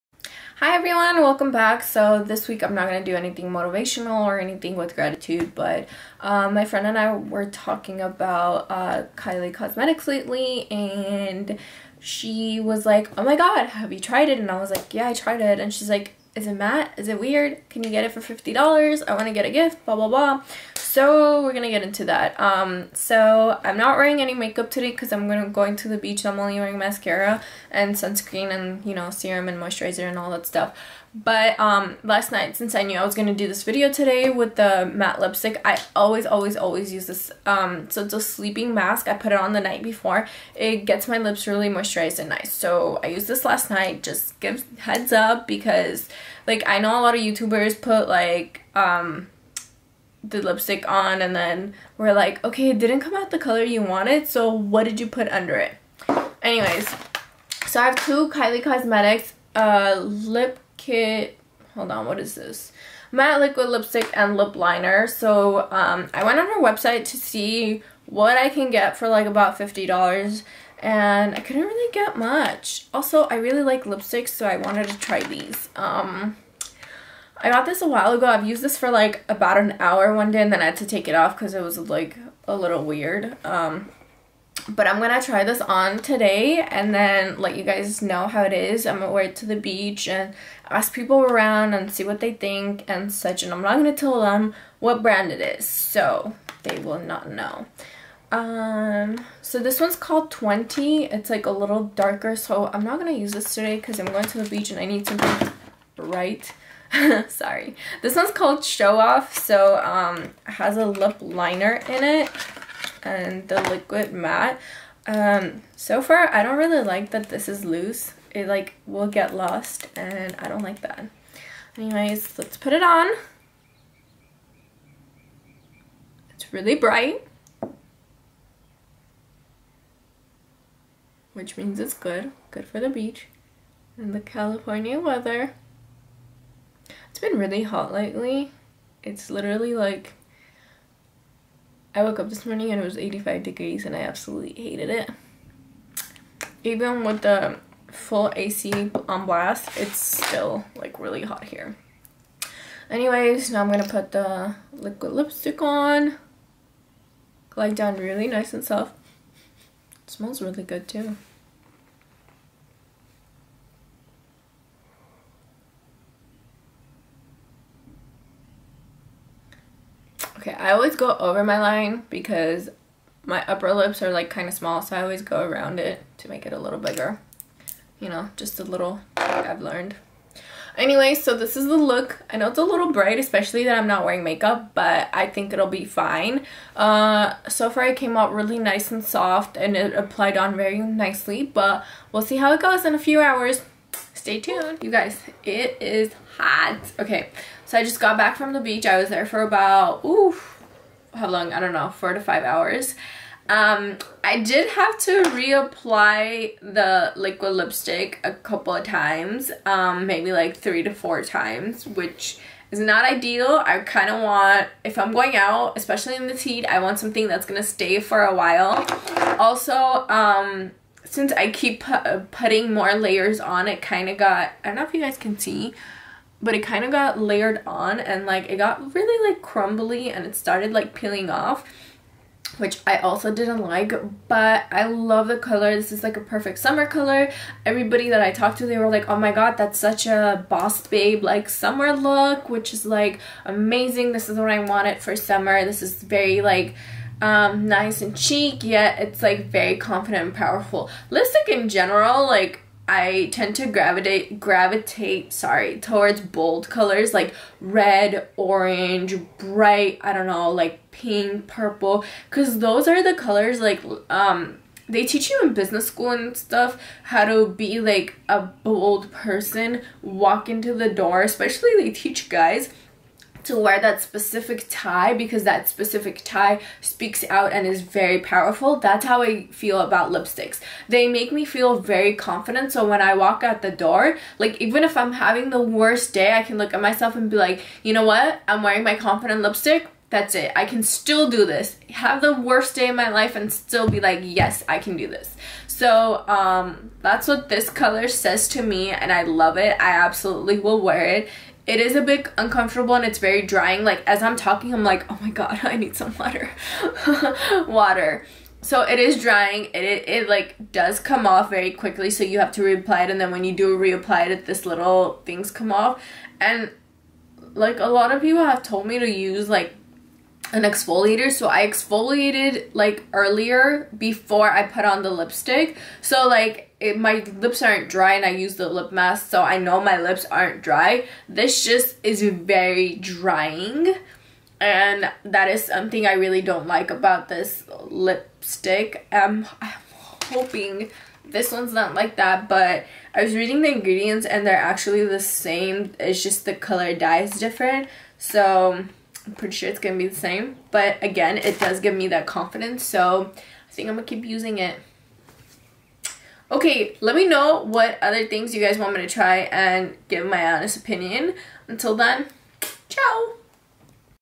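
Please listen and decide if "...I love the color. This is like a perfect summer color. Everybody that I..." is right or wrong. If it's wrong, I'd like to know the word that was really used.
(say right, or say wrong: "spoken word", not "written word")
right.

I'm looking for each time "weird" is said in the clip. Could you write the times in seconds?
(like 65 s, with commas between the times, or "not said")
17 s, 82 s.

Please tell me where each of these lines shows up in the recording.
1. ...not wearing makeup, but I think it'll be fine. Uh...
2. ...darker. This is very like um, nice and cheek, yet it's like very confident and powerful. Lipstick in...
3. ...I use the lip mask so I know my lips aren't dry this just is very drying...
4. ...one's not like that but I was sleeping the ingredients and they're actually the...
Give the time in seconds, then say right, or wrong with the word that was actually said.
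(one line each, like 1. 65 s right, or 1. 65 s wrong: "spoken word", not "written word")
1. 183 s right
2. 245 s wrong: "summer", not "darker"
3. 328 s right
4. 341 s wrong: "reading", not "sleeping".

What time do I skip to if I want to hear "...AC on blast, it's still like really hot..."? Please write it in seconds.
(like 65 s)
148 s.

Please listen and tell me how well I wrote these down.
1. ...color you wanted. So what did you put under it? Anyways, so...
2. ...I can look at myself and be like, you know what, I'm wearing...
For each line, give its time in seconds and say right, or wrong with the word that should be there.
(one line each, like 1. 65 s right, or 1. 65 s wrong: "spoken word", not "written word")
1. 53 s right
2. 286 s right.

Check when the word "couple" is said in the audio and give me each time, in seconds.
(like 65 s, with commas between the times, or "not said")
208 s.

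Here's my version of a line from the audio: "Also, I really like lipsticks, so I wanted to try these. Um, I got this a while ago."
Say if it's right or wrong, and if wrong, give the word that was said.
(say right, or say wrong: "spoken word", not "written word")
right.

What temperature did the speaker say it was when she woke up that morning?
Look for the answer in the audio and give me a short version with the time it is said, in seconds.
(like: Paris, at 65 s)
85 degrees, at 142 s.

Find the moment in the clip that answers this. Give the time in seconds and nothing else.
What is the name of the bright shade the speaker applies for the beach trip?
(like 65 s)
108 s.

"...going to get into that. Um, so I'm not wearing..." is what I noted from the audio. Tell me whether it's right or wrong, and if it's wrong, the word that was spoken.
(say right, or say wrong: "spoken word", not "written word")
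right.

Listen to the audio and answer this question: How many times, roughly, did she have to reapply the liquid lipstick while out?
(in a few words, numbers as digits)
3 to 4 times.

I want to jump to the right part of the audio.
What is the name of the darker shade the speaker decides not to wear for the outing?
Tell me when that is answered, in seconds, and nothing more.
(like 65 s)
100 s.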